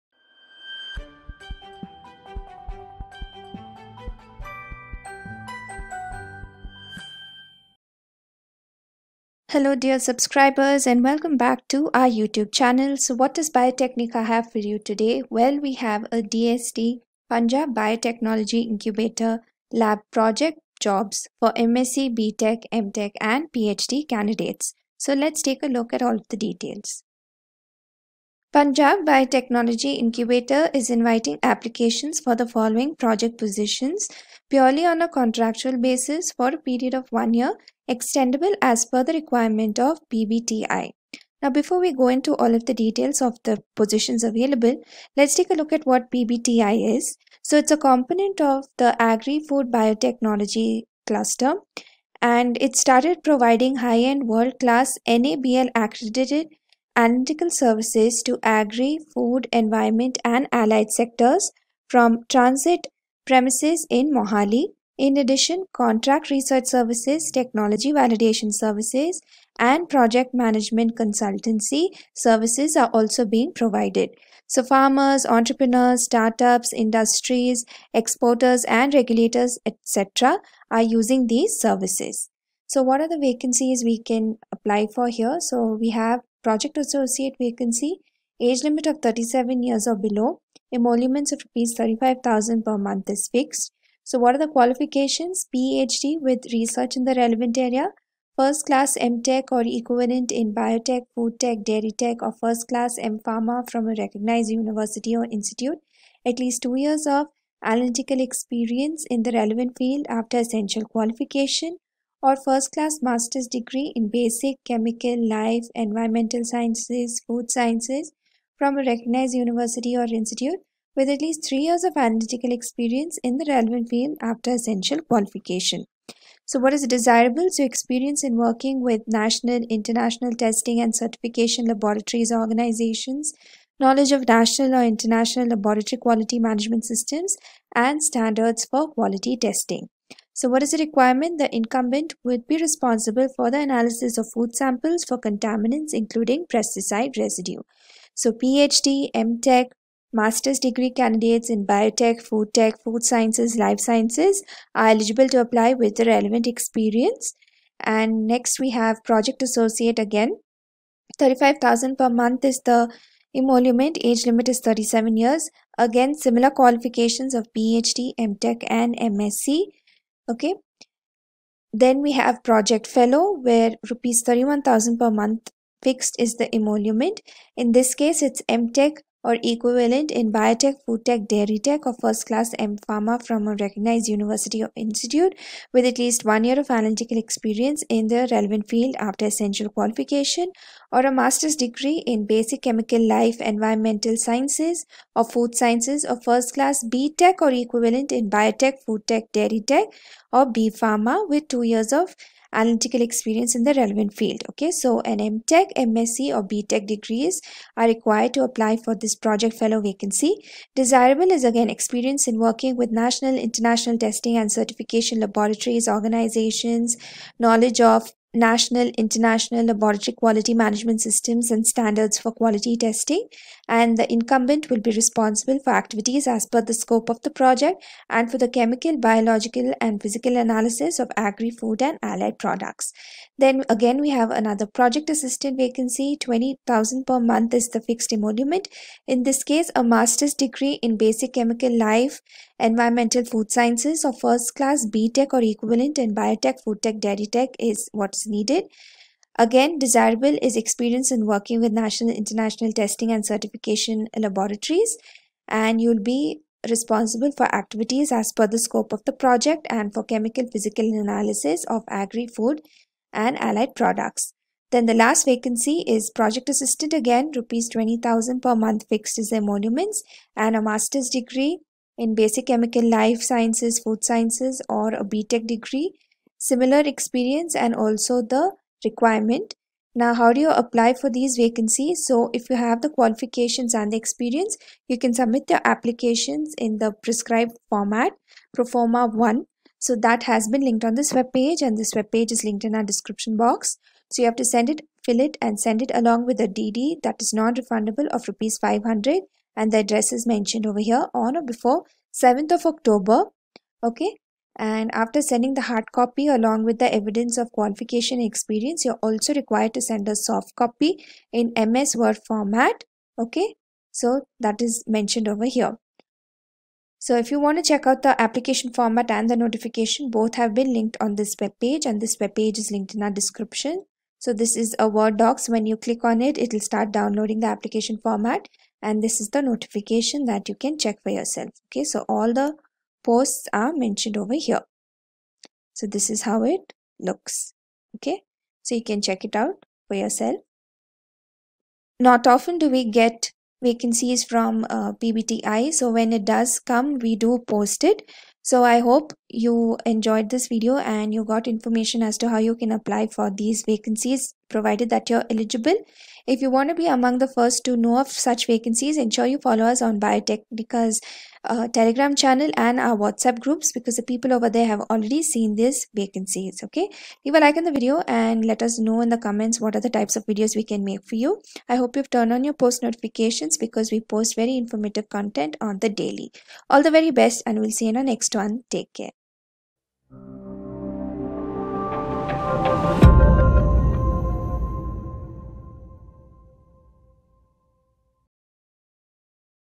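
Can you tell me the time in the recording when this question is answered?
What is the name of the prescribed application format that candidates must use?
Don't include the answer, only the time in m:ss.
4:48.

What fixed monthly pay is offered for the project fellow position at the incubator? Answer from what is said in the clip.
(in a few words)
31,000 rupees.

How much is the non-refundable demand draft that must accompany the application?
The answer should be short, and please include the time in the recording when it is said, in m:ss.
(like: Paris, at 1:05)
500 rupees, at 4:58.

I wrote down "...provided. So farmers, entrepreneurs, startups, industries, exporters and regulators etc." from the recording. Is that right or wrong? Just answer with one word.
right.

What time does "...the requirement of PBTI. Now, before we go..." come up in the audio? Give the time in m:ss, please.
0:39.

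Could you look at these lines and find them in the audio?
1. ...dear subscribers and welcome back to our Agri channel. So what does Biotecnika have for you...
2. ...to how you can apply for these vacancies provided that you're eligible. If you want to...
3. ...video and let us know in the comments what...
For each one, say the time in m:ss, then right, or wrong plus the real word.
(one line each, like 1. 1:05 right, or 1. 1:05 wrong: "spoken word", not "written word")
1. 0:09 wrong: "YouTube", not "Agri"
2. 5:52 right
3. 6:07 right.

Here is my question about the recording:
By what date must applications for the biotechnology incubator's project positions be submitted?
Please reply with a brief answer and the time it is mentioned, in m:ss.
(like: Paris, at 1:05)
7th of October, at 5:02.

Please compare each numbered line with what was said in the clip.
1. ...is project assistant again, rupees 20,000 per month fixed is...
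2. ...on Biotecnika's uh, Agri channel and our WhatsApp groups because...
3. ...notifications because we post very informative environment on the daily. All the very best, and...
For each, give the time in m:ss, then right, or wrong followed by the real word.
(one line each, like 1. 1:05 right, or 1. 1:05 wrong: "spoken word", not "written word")
1. 4:25 right
2. 5:59 wrong: "Telegram", not "Agri"
3. 6:12 wrong: "content", not "environment".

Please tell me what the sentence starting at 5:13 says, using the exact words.
Okay, so that is mentioned over here.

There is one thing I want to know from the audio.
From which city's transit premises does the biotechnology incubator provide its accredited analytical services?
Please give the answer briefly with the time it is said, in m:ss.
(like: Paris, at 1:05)
Mohali, at 1:04.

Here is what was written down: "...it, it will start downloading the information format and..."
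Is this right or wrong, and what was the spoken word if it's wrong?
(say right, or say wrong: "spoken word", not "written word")
wrong: "application", not "information".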